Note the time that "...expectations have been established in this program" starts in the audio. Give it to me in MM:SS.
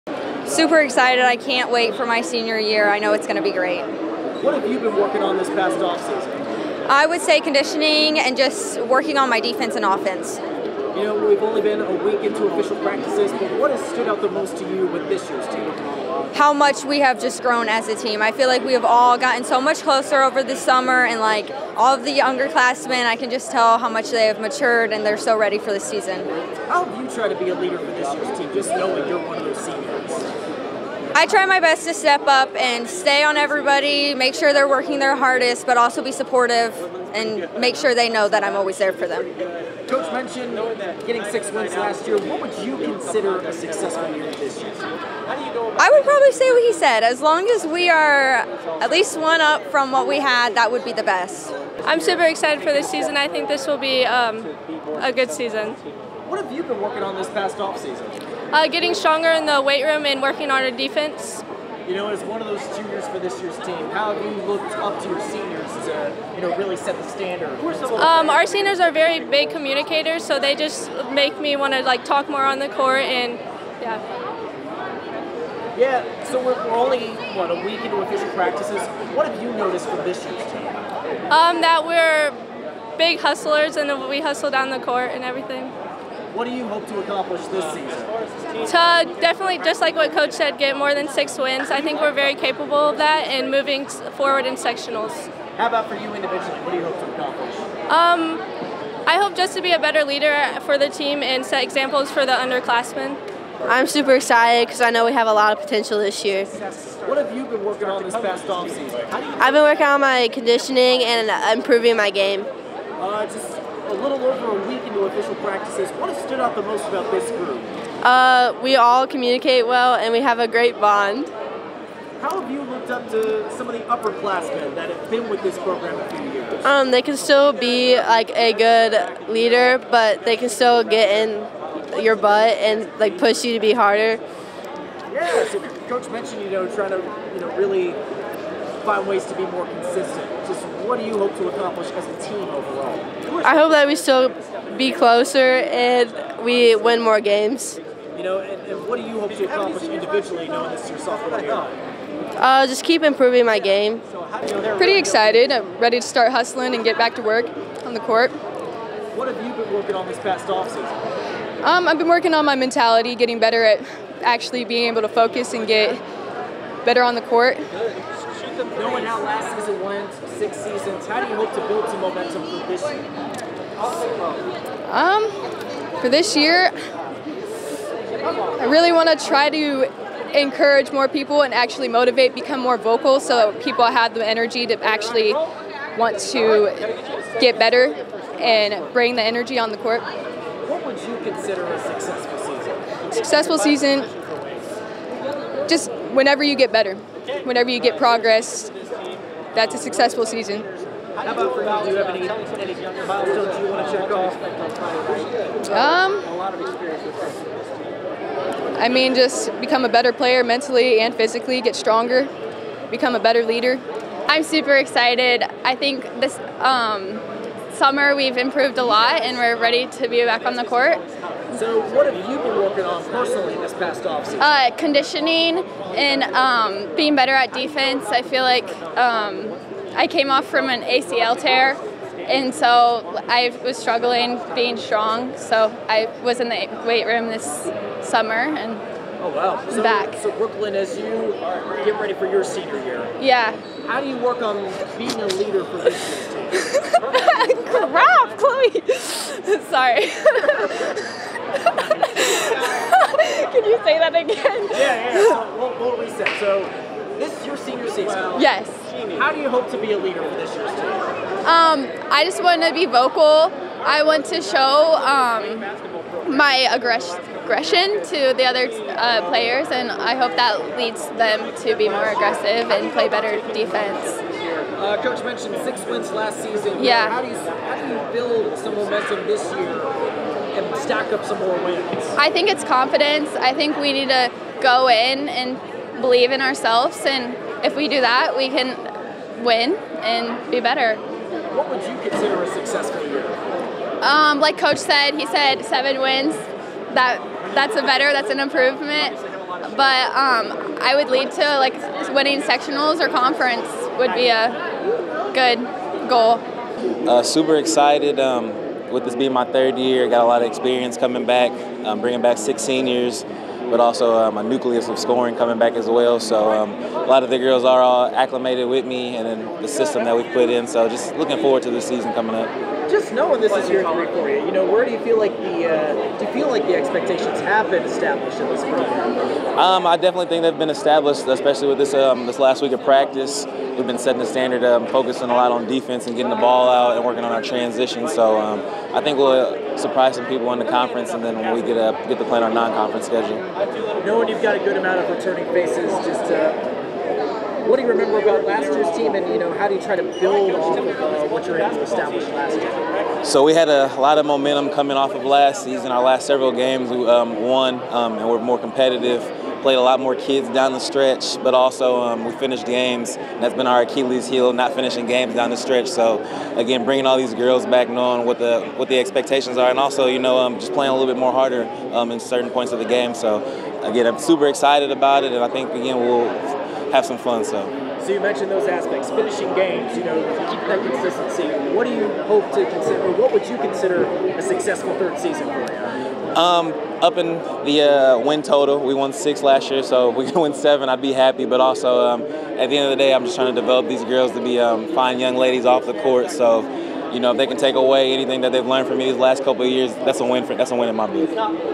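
05:26.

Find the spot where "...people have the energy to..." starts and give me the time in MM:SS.
03:03.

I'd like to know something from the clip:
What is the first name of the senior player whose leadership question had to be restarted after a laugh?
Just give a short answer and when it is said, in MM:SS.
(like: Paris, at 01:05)
Brooklyn, at 04:00.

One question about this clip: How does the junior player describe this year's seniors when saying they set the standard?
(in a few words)
big communicators.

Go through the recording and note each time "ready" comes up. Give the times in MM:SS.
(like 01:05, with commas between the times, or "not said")
00:25, 02:35, 03:39, 04:02.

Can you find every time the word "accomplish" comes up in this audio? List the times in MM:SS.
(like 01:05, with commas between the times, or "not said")
01:27, 01:37, 02:21, 02:29.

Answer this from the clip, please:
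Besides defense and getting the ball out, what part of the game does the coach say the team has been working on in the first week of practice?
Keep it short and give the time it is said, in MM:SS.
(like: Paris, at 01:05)
transition, at 05:37.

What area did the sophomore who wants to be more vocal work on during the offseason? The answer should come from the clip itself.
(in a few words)
mentality.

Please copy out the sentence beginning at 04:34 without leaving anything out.
Uh, Coach mentioned six wins last season.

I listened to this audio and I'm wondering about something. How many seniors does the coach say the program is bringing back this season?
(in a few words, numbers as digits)
6.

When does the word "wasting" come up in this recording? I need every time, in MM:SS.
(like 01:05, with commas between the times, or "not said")
not said.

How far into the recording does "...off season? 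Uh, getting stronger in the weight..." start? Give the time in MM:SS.
00:57.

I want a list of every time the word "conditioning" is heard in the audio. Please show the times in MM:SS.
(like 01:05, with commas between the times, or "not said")
00:07, 01:50, 03:44.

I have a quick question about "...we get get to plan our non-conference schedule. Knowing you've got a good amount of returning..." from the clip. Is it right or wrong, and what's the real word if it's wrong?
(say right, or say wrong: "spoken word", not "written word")
right.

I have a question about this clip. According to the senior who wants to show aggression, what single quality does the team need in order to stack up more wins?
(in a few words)
confidence.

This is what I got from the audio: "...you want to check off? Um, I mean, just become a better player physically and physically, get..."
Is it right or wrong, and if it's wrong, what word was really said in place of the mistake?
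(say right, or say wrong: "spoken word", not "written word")
wrong: "mentally", not "physically".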